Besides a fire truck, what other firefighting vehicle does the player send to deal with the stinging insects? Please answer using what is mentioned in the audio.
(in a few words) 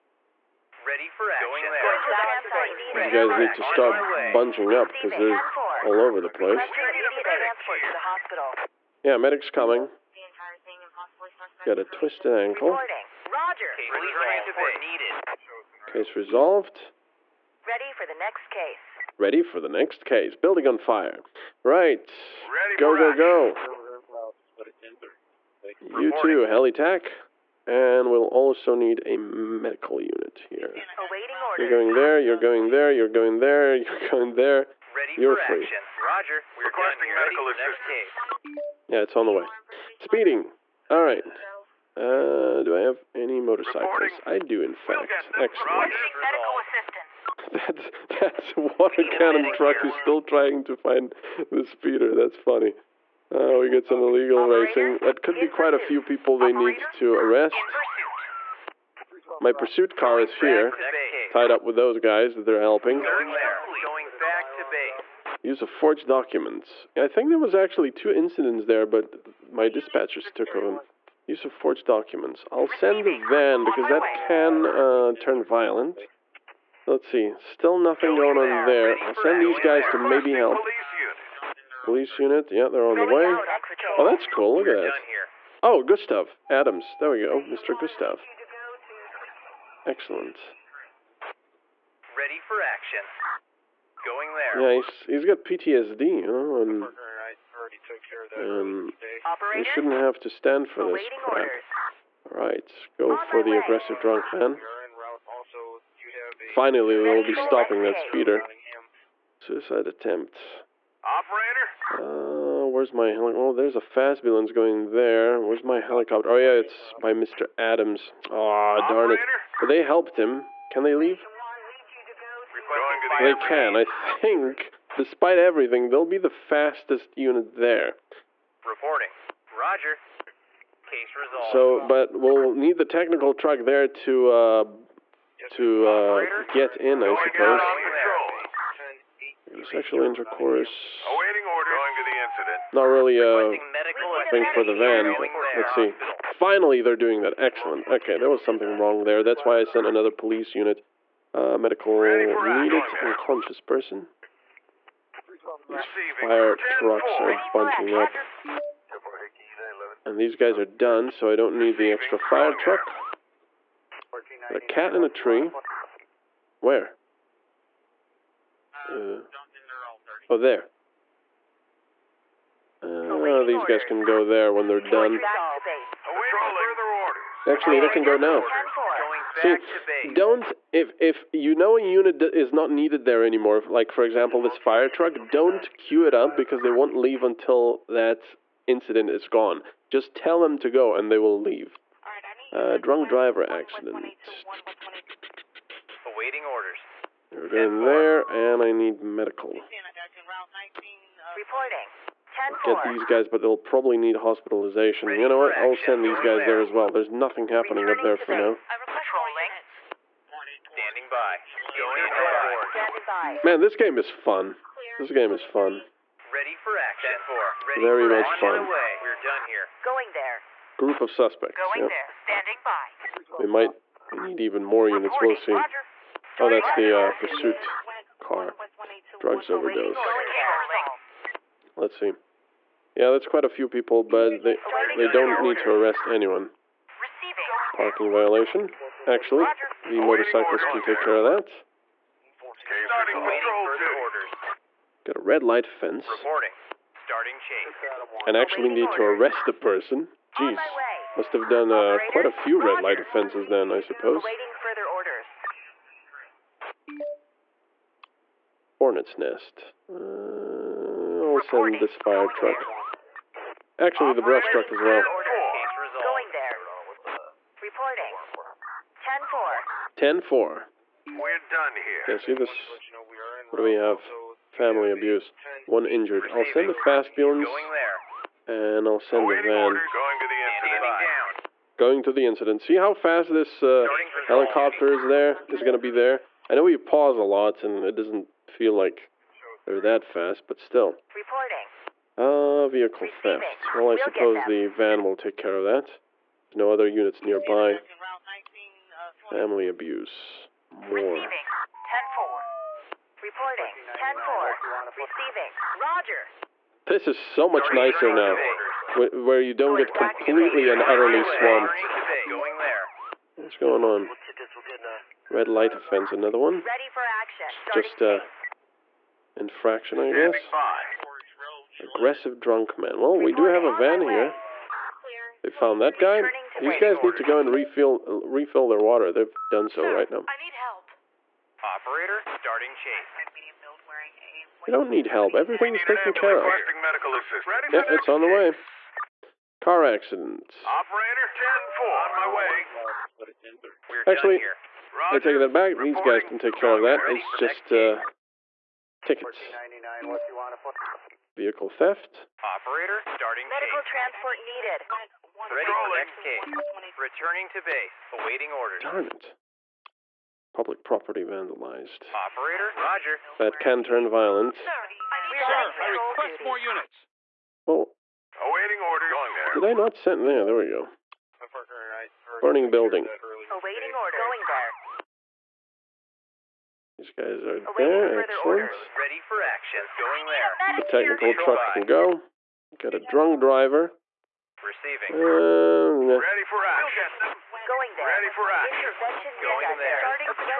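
Brush truck.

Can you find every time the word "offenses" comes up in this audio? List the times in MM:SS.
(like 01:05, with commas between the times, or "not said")
04:12, 05:15.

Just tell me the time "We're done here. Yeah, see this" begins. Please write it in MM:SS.
04:31.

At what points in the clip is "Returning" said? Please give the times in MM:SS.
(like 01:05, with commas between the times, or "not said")
05:56.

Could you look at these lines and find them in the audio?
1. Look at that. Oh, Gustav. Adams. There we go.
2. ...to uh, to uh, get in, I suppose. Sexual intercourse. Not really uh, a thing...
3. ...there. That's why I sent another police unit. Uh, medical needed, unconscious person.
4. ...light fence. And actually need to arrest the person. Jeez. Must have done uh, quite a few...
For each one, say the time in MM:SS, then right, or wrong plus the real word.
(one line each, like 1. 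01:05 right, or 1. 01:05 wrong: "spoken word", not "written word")
1. 01:24 right
2. 02:13 right
3. 02:29 right
4. 04:05 right.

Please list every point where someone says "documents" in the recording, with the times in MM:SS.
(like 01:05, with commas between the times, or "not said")
01:06, 01:11.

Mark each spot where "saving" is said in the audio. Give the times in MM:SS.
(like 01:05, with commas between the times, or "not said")
not said.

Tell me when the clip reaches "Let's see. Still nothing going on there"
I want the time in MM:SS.
01:16.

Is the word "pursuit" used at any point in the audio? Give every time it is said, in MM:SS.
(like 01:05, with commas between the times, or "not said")
00:59, 03:47.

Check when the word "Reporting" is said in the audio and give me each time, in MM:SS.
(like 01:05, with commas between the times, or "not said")
02:08, 05:03.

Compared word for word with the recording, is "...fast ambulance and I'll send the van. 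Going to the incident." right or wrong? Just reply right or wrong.
right.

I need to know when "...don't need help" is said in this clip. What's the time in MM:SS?
05:34.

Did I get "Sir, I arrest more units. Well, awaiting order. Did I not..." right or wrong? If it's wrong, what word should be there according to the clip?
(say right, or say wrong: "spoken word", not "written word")
wrong: "request", not "arrest".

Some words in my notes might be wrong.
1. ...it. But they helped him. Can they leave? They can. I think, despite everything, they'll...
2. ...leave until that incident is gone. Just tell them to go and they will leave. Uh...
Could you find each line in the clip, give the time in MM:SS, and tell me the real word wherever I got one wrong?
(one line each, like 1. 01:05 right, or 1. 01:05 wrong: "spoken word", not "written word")
1. 01:59 right
2. 03:06 right.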